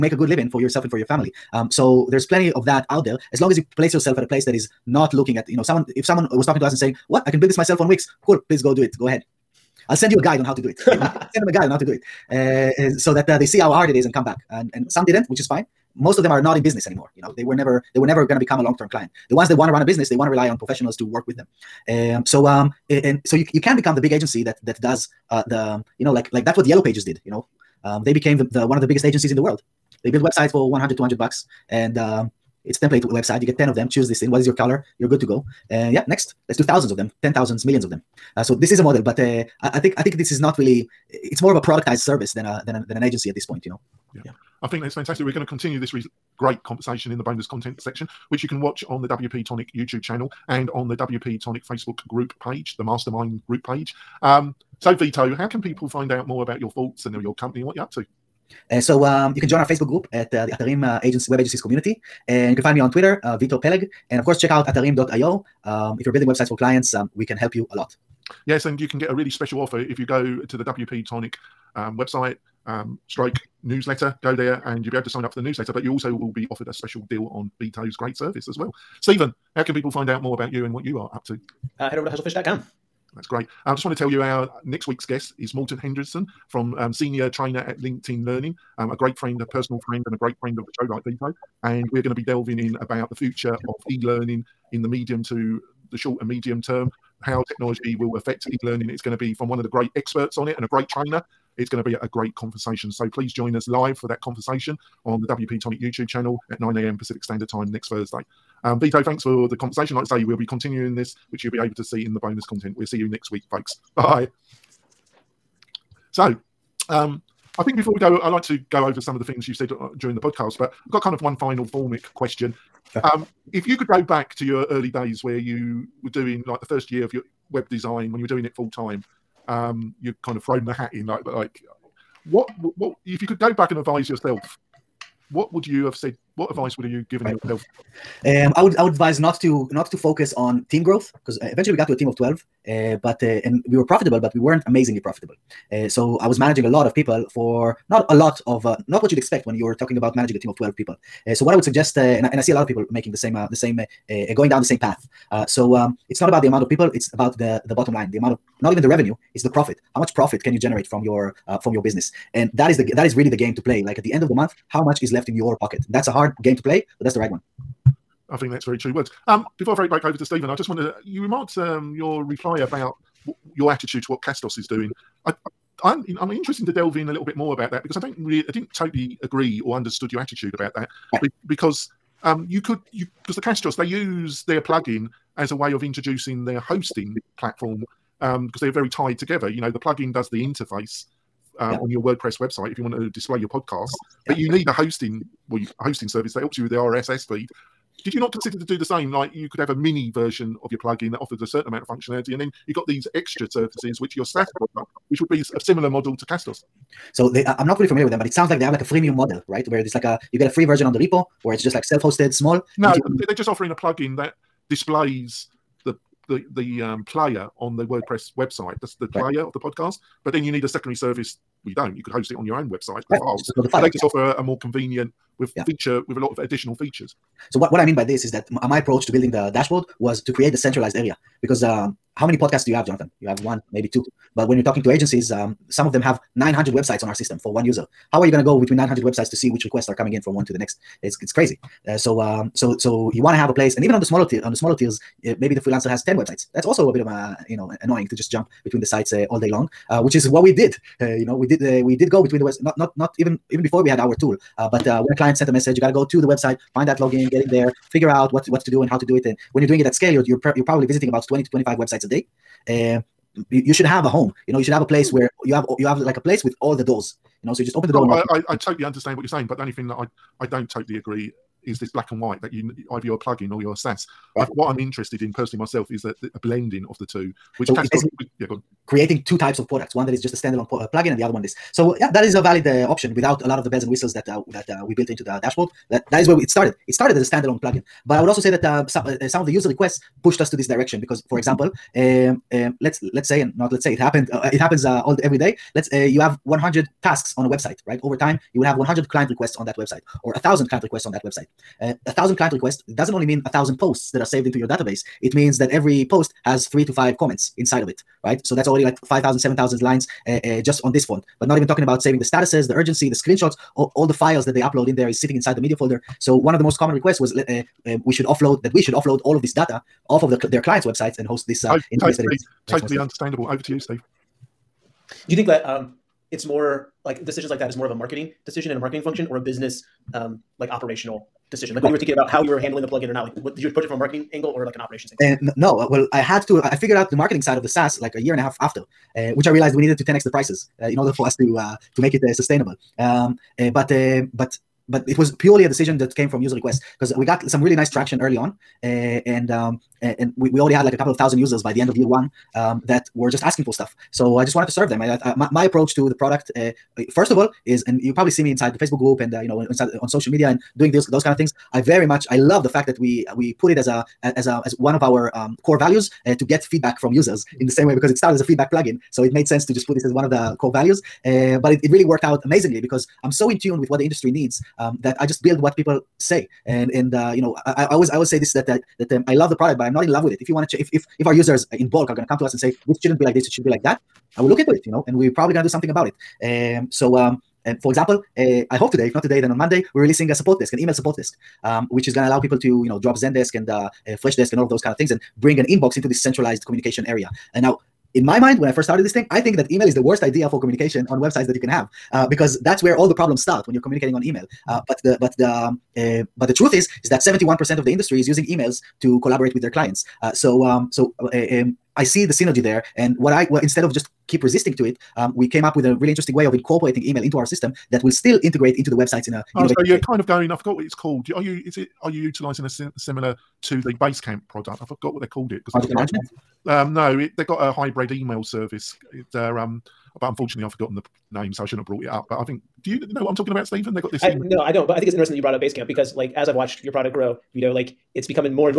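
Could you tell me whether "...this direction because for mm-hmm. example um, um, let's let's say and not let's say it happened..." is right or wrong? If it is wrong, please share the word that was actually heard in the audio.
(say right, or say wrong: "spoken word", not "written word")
right.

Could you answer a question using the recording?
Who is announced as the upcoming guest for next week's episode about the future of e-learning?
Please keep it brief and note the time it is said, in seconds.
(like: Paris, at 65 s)
Morten Henderson, at 85 s.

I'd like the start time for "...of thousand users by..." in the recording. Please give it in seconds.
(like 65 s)
351 s.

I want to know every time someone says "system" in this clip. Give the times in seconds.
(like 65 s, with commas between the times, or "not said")
237 s, 417 s.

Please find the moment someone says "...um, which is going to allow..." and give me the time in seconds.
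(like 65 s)
391 s.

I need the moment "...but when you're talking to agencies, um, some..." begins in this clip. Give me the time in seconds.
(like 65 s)
234 s.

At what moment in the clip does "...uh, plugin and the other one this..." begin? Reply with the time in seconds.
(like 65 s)
280 s.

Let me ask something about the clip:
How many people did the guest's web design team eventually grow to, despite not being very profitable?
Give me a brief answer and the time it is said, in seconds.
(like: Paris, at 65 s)
12, at 142 s.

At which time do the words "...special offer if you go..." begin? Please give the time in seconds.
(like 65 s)
69 s.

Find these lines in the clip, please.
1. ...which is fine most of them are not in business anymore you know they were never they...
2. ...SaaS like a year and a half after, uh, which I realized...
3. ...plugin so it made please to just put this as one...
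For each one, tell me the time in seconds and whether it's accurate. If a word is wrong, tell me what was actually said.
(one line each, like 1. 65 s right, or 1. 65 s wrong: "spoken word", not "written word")
1. 15 s right
2. 337 s right
3. 368 s wrong: "sense", not "please".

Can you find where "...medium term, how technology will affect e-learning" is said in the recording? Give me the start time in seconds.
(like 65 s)
96 s.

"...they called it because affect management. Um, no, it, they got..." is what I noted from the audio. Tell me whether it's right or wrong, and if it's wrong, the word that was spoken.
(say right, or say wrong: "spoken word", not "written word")
wrong: "project", not "affect".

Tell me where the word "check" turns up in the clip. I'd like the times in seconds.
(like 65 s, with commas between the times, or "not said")
64 s.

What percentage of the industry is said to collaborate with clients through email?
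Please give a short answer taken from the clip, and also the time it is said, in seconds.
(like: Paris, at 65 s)
71%, at 407 s.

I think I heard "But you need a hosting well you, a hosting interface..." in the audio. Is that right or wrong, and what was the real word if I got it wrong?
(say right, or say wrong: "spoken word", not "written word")
wrong: "service", not "interface".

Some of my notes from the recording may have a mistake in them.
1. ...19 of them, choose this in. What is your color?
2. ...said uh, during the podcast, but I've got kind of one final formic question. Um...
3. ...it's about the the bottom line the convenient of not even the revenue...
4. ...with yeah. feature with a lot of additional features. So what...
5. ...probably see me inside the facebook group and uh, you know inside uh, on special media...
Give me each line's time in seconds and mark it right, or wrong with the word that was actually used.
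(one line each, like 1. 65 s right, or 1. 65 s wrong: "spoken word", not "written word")
1. 33 s wrong: "10", not "19"
2. 119 s right
3. 156 s wrong: "amount", not "convenient"
4. 225 s right
5. 358 s wrong: "social", not "special".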